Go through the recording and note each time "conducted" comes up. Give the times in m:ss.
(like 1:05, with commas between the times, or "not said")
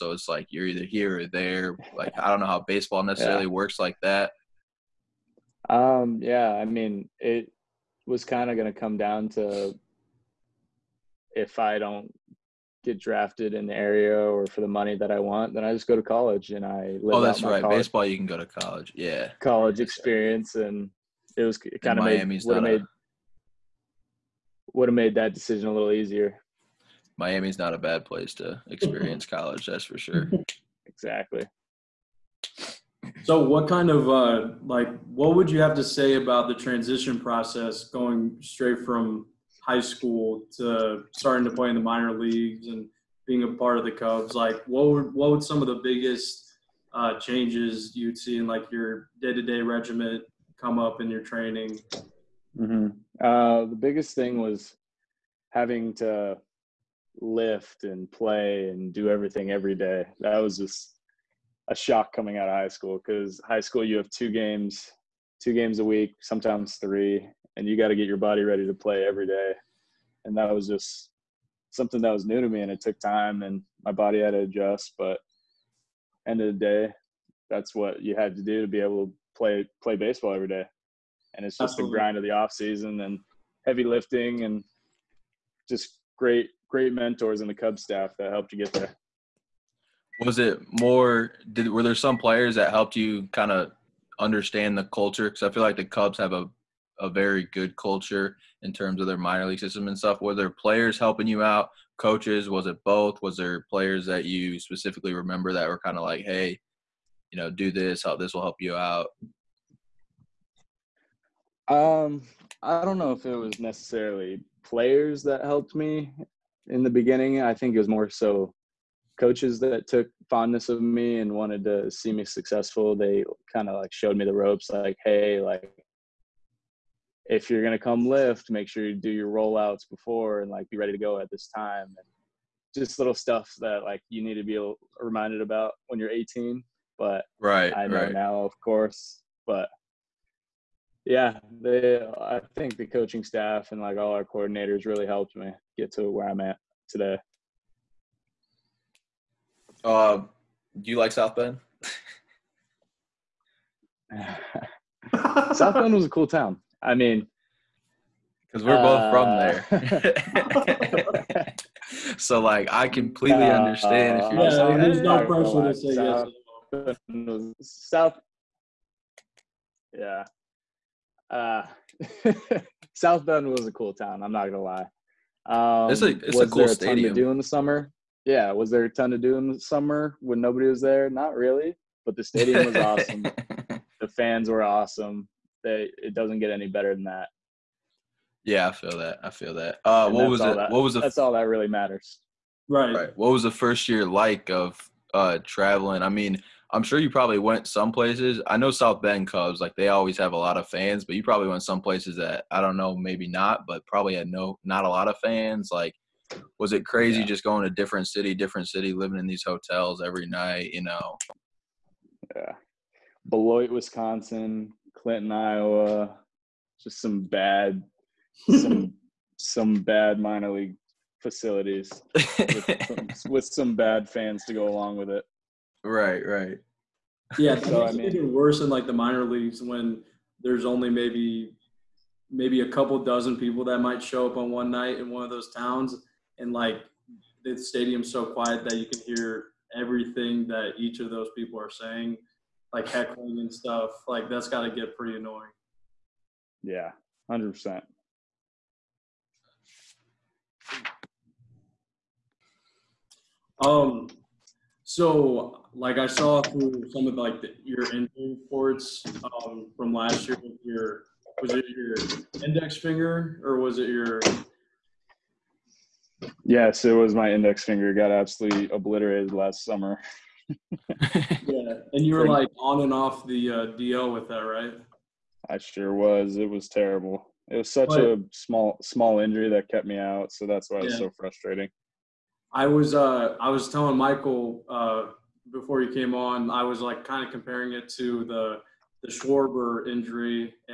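not said.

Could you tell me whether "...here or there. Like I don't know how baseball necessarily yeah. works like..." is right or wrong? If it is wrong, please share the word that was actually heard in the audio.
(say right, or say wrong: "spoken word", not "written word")
right.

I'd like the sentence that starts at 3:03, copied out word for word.
The fans were awesome that it doesn't get any better than that.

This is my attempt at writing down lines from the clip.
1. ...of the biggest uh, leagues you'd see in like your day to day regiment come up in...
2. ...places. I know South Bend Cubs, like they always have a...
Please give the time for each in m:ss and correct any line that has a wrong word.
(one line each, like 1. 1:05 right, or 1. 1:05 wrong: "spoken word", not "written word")
1. 0:45 wrong: "changes", not "leagues"
2. 3:17 right.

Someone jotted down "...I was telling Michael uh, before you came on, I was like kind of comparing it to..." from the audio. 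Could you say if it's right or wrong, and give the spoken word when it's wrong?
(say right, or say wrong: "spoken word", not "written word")
right.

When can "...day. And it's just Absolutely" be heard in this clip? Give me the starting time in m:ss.
1:20.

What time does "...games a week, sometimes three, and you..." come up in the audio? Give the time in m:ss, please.
1:05.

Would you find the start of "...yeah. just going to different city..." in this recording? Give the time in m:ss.
3:27.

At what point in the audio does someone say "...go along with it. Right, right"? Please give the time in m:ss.
3:44.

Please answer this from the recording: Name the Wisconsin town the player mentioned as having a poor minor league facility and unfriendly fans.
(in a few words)
Beloit.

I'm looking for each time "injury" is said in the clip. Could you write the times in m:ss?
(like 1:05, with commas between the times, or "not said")
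4:17, 4:39, 4:49.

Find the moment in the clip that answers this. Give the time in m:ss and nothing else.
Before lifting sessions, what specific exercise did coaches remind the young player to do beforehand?
2:09.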